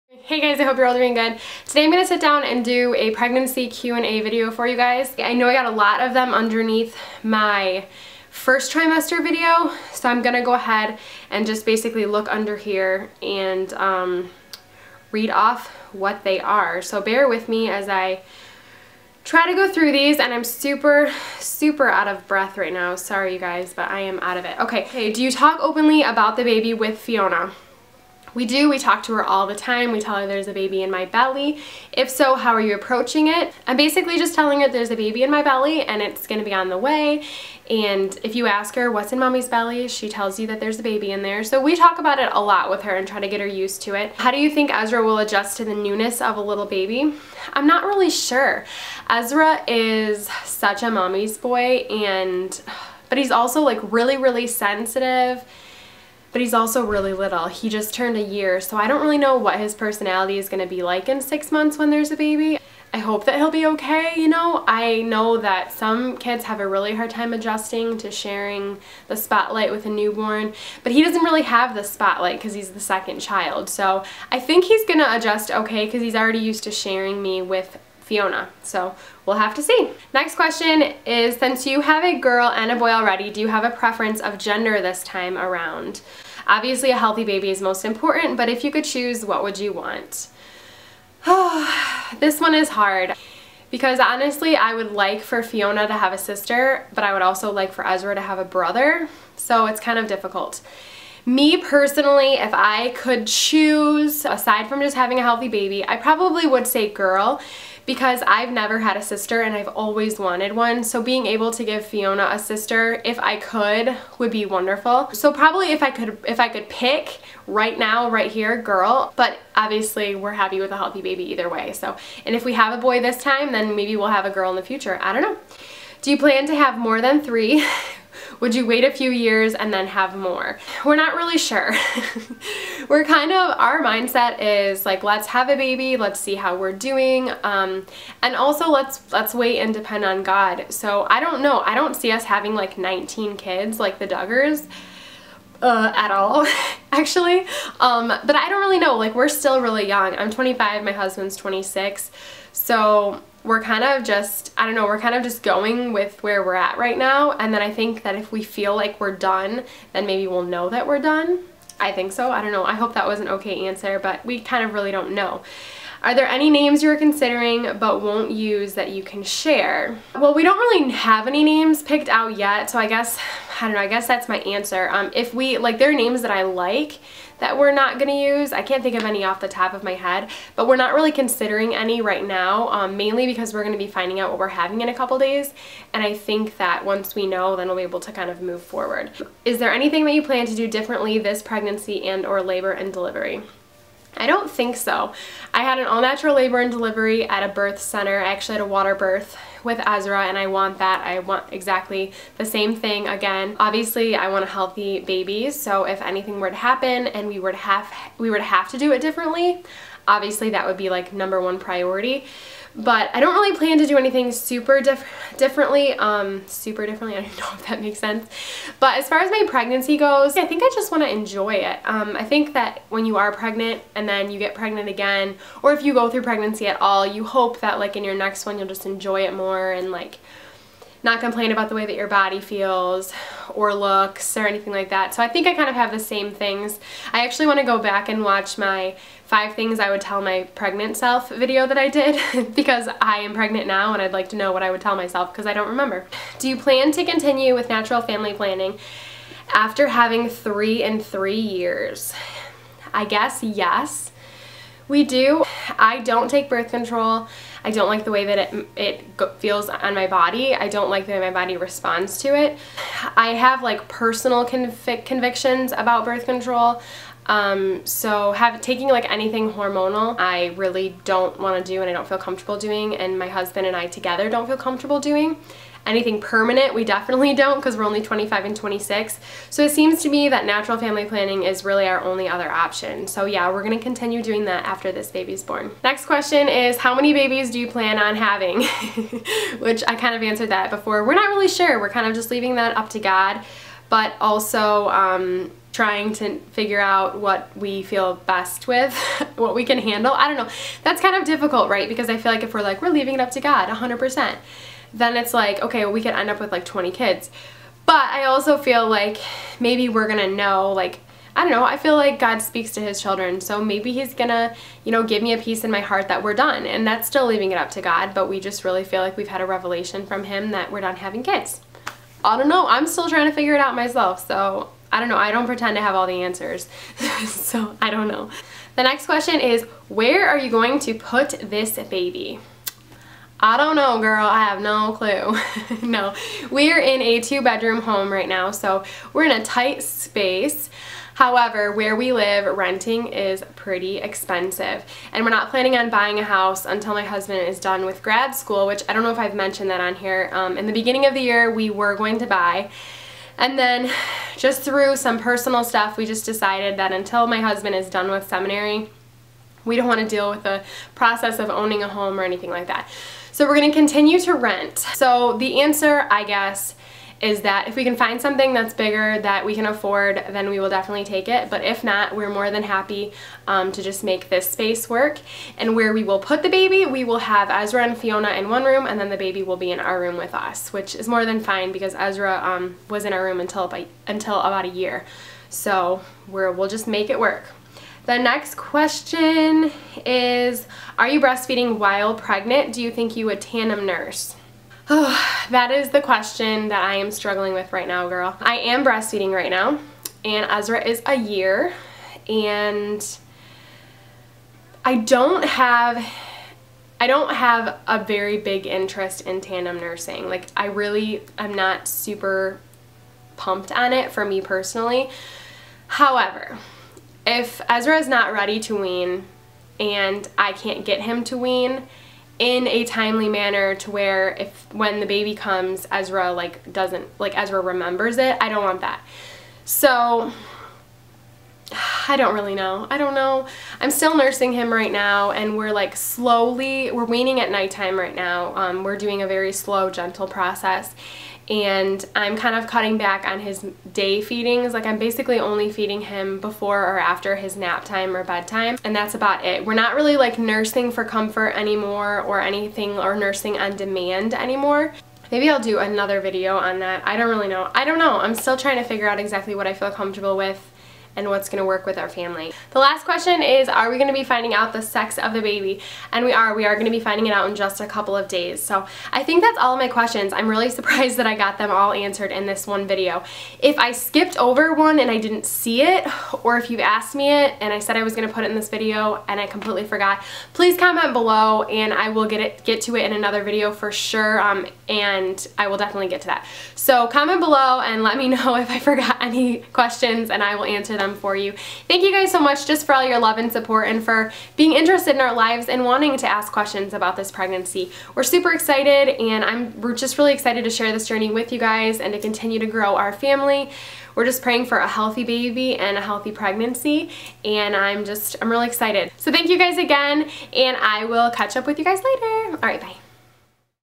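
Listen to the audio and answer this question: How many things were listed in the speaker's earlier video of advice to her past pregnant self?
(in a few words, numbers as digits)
5.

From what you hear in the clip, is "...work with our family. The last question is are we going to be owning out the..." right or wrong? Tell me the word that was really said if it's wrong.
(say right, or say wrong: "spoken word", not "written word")
wrong: "finding", not "owning".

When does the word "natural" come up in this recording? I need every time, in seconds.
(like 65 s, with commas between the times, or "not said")
195 s, 247 s, 280 s.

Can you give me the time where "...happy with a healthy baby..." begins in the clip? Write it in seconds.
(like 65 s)
120 s.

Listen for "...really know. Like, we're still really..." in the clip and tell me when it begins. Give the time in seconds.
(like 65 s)
148 s.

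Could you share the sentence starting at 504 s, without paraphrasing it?
We're just praying for a healthy baby and a healthy pregnancy and I'm just, I'm really excited.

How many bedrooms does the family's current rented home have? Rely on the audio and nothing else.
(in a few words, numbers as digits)
2.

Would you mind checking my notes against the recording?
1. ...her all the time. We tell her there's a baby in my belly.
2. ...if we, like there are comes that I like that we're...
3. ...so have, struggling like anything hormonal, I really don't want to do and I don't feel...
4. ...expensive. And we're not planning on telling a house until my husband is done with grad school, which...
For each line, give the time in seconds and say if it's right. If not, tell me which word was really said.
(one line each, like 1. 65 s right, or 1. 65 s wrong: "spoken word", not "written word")
1. 29 s right
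2. 175 s wrong: "names", not "comes"
3. 267 s wrong: "taking", not "struggling"
4. 343 s wrong: "buying", not "telling".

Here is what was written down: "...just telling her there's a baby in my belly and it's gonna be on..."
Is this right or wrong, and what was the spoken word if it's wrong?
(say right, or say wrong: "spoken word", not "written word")
right.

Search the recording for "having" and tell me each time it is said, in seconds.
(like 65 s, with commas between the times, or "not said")
104 s, 142 s, 184 s, 249 s, 288 s, 320 s.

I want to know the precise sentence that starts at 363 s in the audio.
So we're going to continue to rent.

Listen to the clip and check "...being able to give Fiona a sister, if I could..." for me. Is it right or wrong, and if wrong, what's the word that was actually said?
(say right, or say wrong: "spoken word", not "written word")
right.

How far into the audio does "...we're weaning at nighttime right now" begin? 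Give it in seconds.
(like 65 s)
436 s.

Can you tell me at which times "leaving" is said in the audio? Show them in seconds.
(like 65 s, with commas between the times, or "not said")
292 s, 302 s, 317 s.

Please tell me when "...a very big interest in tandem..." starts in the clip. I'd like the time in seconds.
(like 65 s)
407 s.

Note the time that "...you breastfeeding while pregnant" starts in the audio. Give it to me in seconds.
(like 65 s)
391 s.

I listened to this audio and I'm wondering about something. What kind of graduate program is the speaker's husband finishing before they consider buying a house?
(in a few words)
seminary.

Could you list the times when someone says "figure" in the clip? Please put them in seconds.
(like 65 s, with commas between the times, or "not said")
296 s, 323 s, 458 s.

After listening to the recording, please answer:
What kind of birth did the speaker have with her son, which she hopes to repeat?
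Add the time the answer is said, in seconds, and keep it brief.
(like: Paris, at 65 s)
water birth, at 198 s.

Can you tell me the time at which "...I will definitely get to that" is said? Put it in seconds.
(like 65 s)
485 s.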